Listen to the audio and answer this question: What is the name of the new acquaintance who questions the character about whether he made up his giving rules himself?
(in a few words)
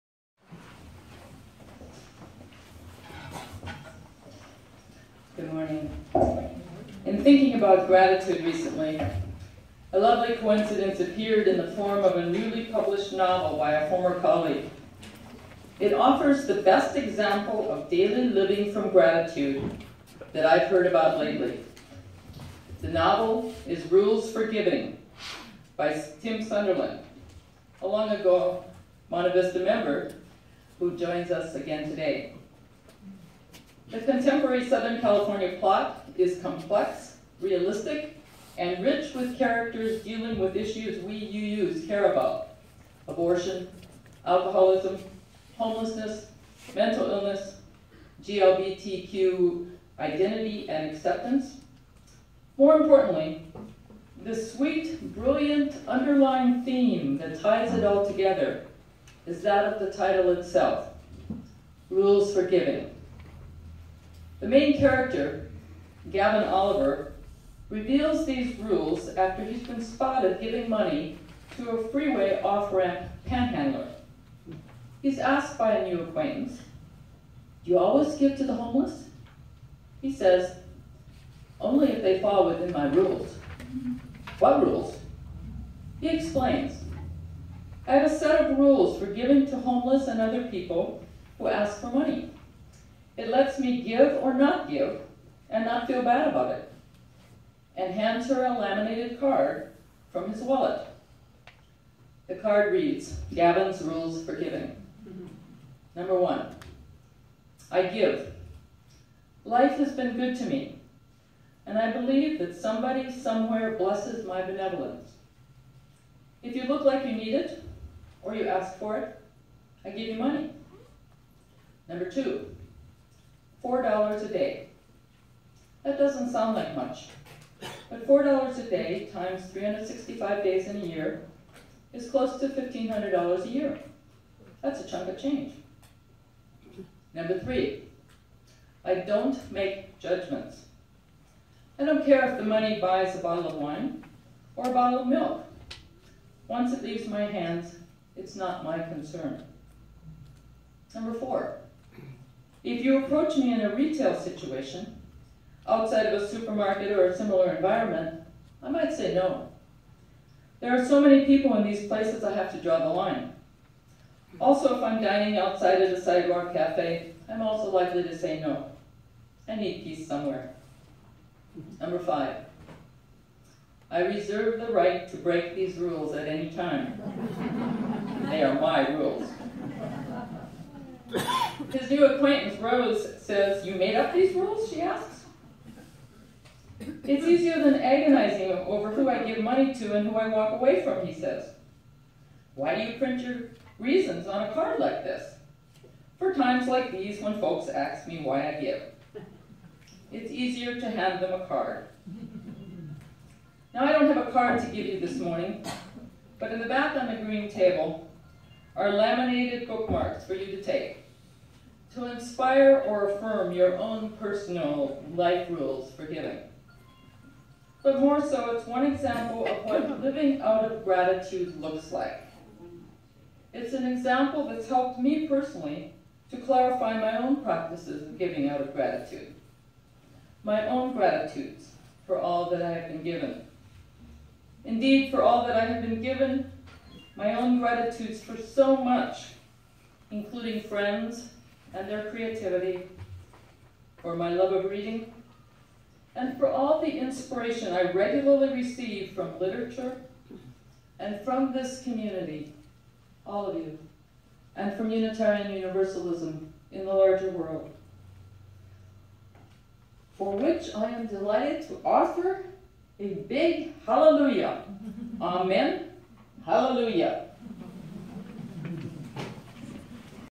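Rose.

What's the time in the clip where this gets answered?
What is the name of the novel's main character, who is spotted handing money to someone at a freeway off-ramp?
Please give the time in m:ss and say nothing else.
1:06.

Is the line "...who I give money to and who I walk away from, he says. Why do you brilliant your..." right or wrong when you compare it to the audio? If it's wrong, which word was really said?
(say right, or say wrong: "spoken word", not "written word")
wrong: "print", not "brilliant".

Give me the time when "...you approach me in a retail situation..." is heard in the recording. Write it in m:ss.
2:32.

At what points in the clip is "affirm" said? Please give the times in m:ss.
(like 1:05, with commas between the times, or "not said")
3:33.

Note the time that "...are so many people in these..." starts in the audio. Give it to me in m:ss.
2:40.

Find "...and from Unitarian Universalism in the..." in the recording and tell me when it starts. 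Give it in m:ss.
4:14.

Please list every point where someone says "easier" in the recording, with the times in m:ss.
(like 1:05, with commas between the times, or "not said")
3:07, 3:20.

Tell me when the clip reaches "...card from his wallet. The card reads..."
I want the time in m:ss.
1:39.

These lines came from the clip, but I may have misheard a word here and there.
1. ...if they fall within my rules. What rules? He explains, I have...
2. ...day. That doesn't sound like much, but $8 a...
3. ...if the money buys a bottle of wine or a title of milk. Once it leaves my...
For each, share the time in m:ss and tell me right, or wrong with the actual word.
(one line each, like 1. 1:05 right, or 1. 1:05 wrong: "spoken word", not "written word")
1. 1:21 right
2. 2:04 wrong: "4", not "8"
3. 2:22 wrong: "bottle", not "title".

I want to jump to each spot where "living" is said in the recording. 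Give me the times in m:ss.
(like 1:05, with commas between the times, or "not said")
0:18, 3:40.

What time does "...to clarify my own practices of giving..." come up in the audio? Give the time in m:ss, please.
3:46.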